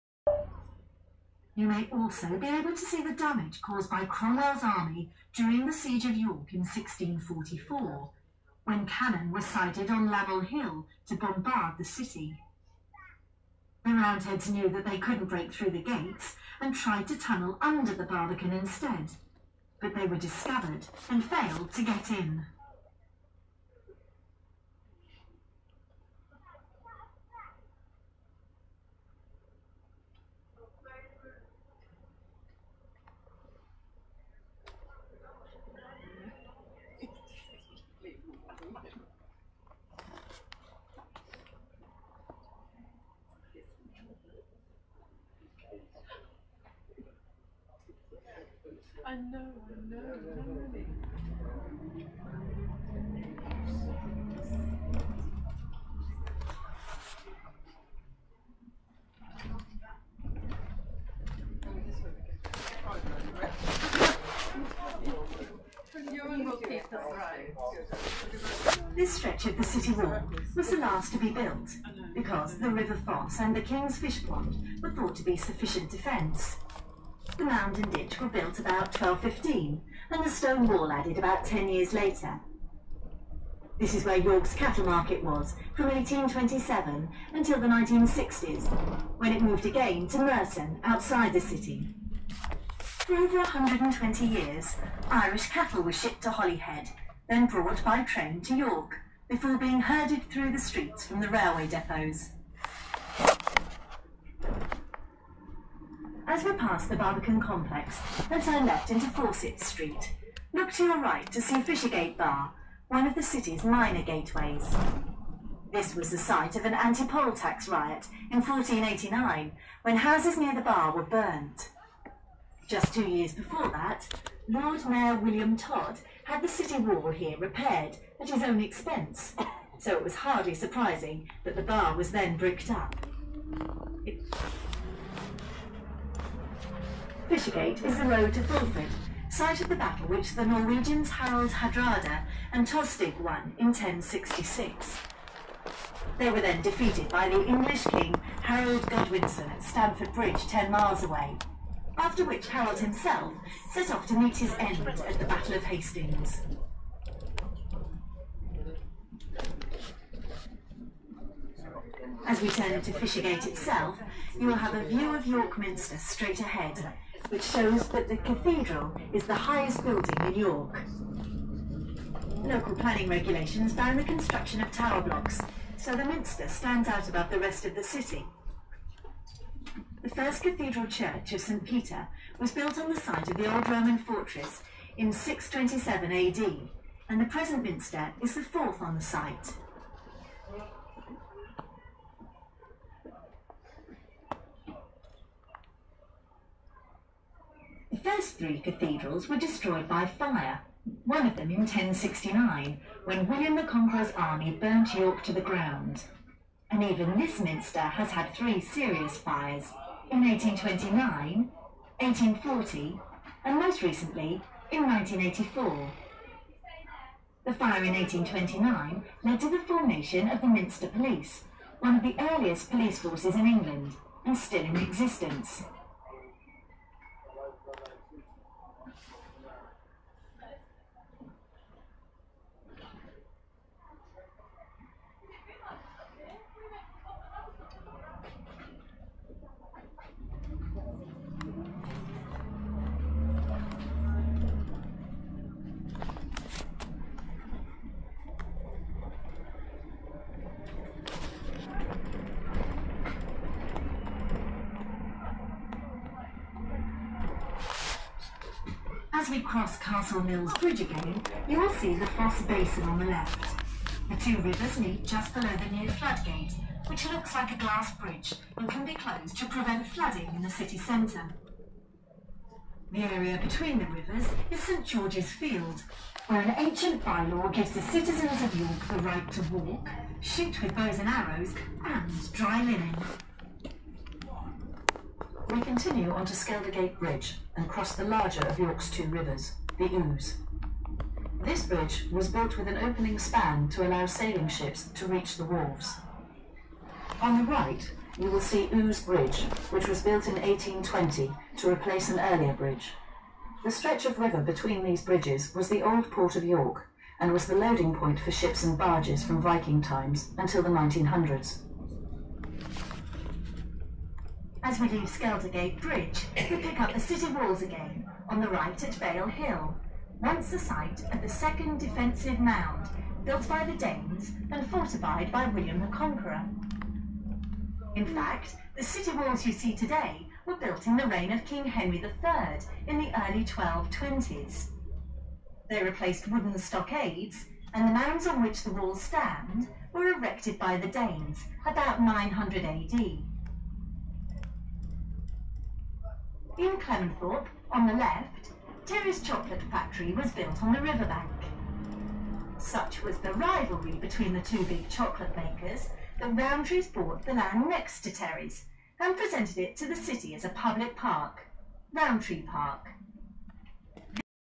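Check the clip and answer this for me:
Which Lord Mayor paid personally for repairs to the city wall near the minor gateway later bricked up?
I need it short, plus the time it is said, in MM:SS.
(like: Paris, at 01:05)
William Todd, at 02:05.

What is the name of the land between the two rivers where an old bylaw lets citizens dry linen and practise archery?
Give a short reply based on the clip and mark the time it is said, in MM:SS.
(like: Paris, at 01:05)
St George's Field, at 04:34.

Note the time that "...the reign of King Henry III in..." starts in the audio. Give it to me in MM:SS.
05:30.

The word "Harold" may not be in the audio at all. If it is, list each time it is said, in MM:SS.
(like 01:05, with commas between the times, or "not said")
02:28, 02:32.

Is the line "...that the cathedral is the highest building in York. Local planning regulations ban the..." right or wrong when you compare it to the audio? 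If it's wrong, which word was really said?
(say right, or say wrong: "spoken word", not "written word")
right.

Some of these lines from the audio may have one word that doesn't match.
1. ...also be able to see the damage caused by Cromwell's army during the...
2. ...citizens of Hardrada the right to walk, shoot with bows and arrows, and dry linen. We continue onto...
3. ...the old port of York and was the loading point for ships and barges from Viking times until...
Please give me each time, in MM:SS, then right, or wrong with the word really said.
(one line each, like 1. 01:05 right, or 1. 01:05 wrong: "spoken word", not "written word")
1. 00:01 right
2. 04:37 wrong: "York", not "Hardrada"
3. 05:05 right.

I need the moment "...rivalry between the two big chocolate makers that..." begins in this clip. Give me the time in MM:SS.
05:53.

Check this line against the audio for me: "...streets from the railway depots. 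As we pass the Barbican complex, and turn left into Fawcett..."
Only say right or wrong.
right.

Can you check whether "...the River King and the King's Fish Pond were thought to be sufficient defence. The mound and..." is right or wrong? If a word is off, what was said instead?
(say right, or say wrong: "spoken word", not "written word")
wrong: "Foss", not "King".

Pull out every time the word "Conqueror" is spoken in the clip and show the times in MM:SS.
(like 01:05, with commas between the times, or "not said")
03:23, 05:25.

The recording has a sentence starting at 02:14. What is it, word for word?
It Fishergate is the road to Fulford, site of the battle which the Norwegians Harald Hardrada and Tostig won in 1066.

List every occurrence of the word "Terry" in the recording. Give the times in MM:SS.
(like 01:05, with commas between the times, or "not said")
05:48, 05:58.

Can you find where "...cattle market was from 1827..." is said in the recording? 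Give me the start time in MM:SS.
01:24.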